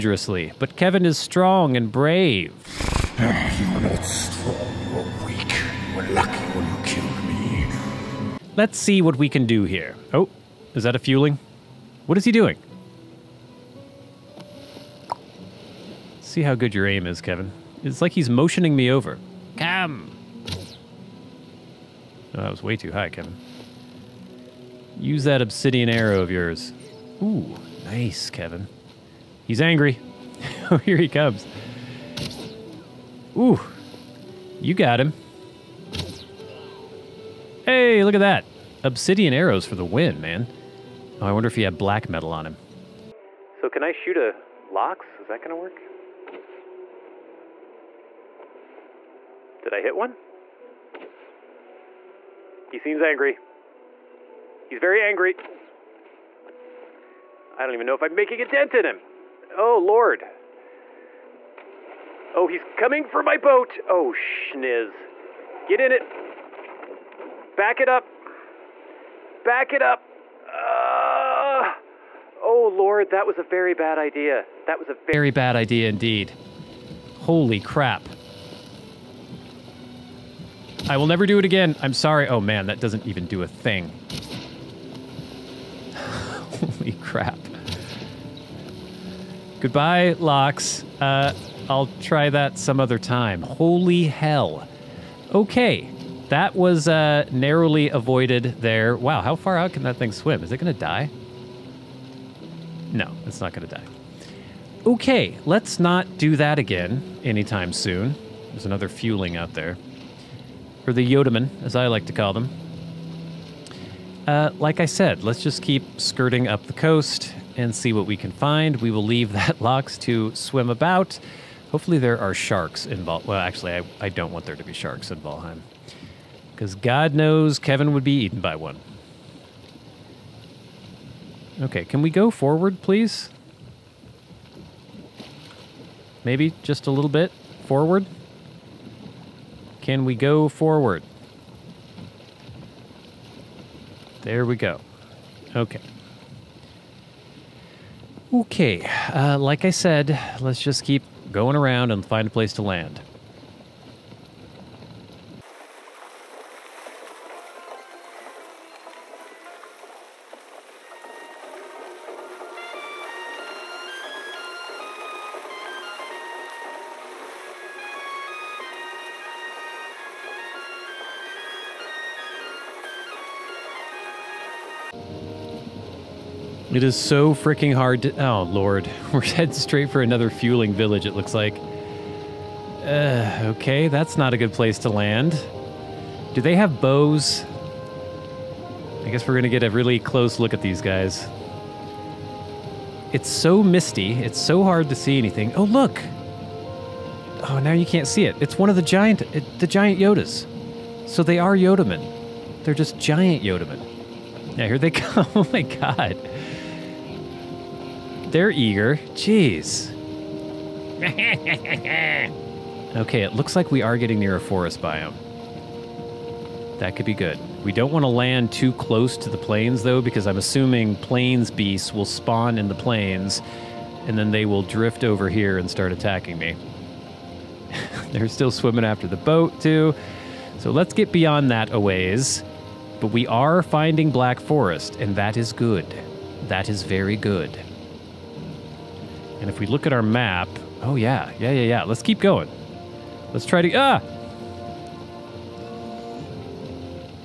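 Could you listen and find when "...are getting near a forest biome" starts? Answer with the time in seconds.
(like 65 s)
213 s.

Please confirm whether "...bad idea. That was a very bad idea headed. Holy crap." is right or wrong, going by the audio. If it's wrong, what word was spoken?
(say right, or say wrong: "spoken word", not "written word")
wrong: "indeed", not "headed".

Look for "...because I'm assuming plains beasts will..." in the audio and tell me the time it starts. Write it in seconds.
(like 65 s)
219 s.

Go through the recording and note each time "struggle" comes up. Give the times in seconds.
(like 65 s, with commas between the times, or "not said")
not said.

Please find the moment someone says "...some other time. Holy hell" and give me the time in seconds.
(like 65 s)
92 s.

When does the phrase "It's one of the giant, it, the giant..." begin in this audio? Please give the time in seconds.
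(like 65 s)
198 s.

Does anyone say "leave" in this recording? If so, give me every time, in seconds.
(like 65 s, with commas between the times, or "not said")
119 s.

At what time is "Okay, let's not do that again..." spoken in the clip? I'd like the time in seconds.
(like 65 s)
104 s.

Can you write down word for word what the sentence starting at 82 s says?
Oh, man, that doesn't even do a thing.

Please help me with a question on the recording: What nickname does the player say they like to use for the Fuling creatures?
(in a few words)
Yodaman.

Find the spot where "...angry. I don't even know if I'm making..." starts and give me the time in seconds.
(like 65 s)
55 s.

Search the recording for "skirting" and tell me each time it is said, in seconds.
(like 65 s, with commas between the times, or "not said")
115 s.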